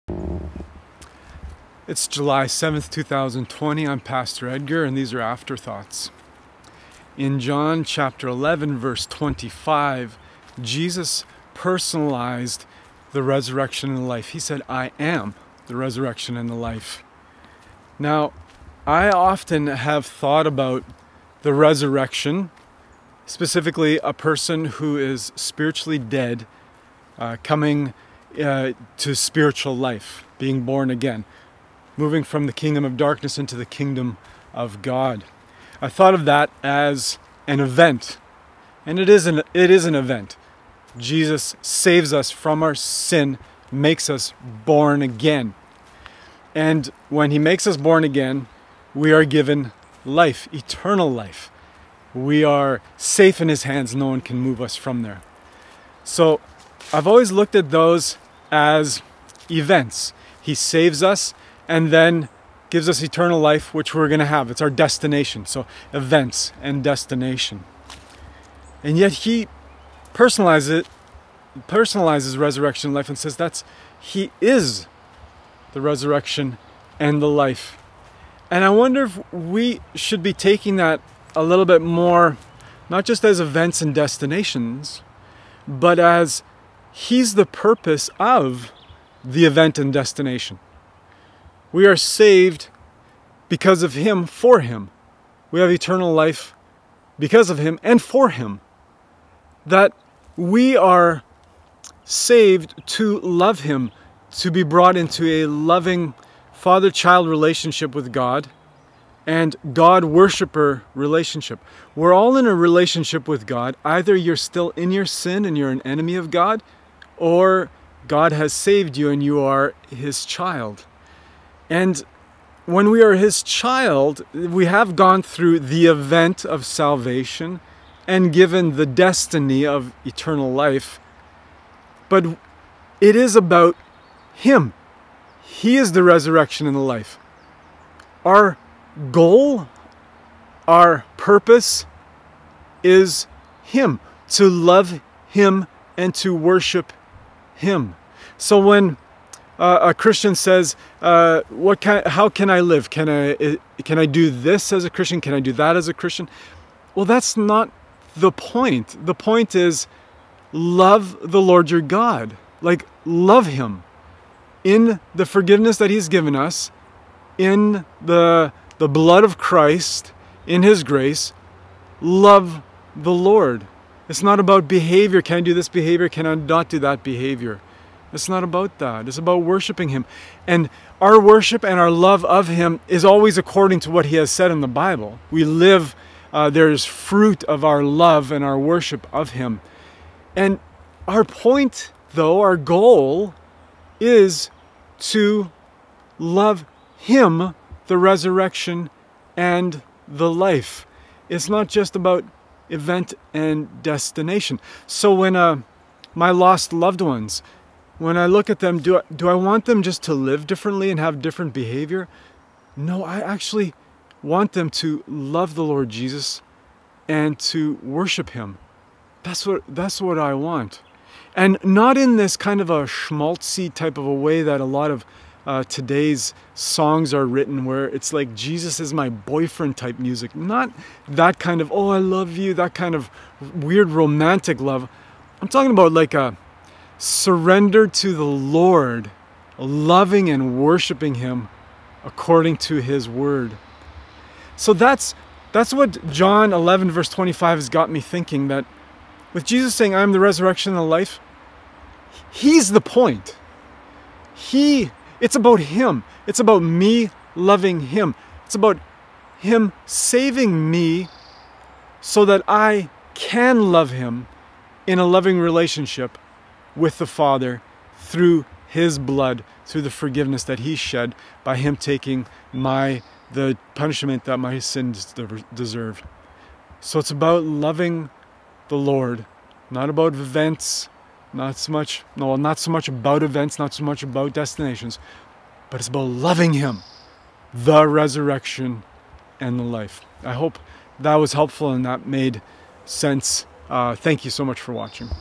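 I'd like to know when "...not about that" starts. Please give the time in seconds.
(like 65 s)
178 s.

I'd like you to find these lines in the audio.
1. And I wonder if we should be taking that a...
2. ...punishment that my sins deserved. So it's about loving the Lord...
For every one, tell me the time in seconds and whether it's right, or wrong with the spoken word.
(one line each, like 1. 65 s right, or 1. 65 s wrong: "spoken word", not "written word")
1. 78 s right
2. 273 s right.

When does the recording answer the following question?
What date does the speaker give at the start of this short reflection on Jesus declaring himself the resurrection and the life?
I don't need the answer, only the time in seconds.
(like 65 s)
2 s.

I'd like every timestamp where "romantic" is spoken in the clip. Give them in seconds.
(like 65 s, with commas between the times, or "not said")
233 s.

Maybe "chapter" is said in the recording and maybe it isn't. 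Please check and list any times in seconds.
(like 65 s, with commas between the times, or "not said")
7 s.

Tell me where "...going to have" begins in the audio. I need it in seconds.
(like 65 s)
64 s.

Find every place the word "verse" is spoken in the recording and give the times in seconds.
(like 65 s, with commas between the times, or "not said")
8 s, 246 s.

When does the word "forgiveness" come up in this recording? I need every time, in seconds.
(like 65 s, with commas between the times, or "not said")
165 s, 269 s.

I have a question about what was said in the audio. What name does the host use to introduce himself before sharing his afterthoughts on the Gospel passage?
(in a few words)
Pastor Edgar.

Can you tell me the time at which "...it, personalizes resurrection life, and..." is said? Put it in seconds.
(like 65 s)
70 s.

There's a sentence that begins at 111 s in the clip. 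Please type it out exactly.
We're all in a relationship with God.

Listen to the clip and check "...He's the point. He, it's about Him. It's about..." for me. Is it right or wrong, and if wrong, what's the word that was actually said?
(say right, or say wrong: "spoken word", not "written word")
right.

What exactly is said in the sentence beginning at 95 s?
We have eternal life because of Him and for Him.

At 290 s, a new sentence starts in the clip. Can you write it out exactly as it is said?
I hope that was helpful and that made sense.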